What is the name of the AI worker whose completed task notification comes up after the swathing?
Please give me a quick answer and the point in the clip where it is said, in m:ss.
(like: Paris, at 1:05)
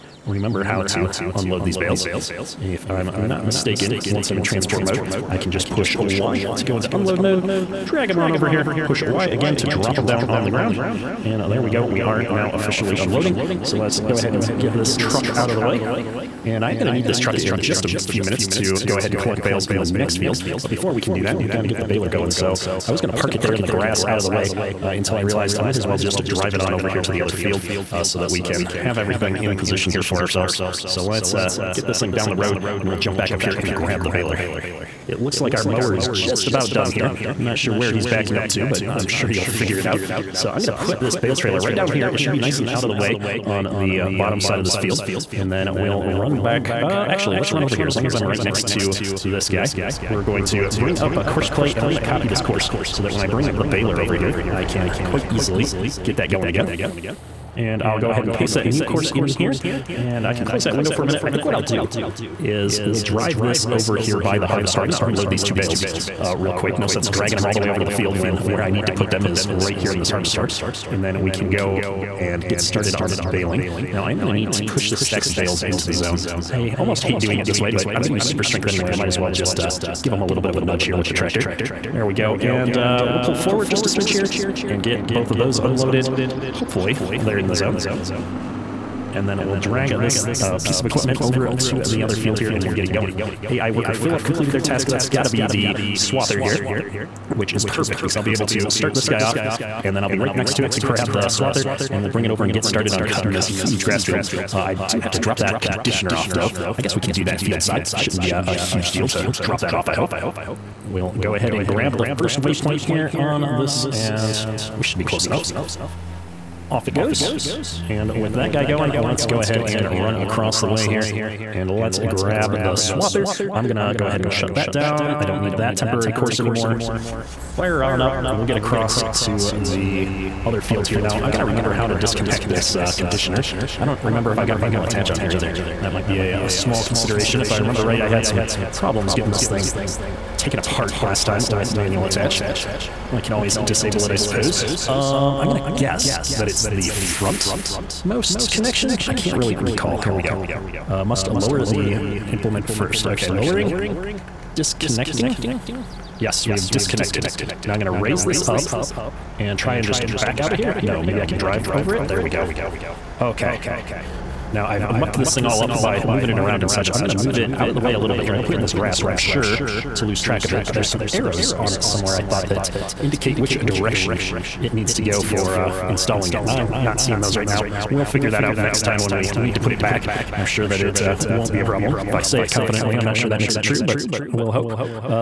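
Philip, at 1:33.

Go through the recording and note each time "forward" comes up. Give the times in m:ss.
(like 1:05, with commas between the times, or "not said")
1:23.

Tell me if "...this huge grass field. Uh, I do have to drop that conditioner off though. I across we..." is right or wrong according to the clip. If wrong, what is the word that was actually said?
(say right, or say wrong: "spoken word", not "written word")
wrong: "guess", not "across".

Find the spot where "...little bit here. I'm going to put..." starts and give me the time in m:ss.
2:47.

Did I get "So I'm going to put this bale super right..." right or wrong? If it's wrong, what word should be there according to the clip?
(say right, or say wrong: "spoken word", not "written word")
wrong: "trailer", not "super".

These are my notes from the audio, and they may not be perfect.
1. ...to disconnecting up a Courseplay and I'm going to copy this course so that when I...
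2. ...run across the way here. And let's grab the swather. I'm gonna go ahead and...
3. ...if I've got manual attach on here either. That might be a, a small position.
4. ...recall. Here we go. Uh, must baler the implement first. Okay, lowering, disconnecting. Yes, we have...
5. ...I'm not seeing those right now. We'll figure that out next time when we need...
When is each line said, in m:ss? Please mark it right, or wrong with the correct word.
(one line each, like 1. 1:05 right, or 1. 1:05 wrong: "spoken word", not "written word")
1. 0:50 wrong: "bring", not "disconnecting"
2. 1:59 right
3. 2:14 wrong: "consideration", not "position"
4. 2:29 wrong: "lower", not "baler"
5. 2:56 right.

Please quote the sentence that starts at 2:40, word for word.
No, maybe I can drive over it.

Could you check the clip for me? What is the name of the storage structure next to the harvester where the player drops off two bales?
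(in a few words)
Harvestore.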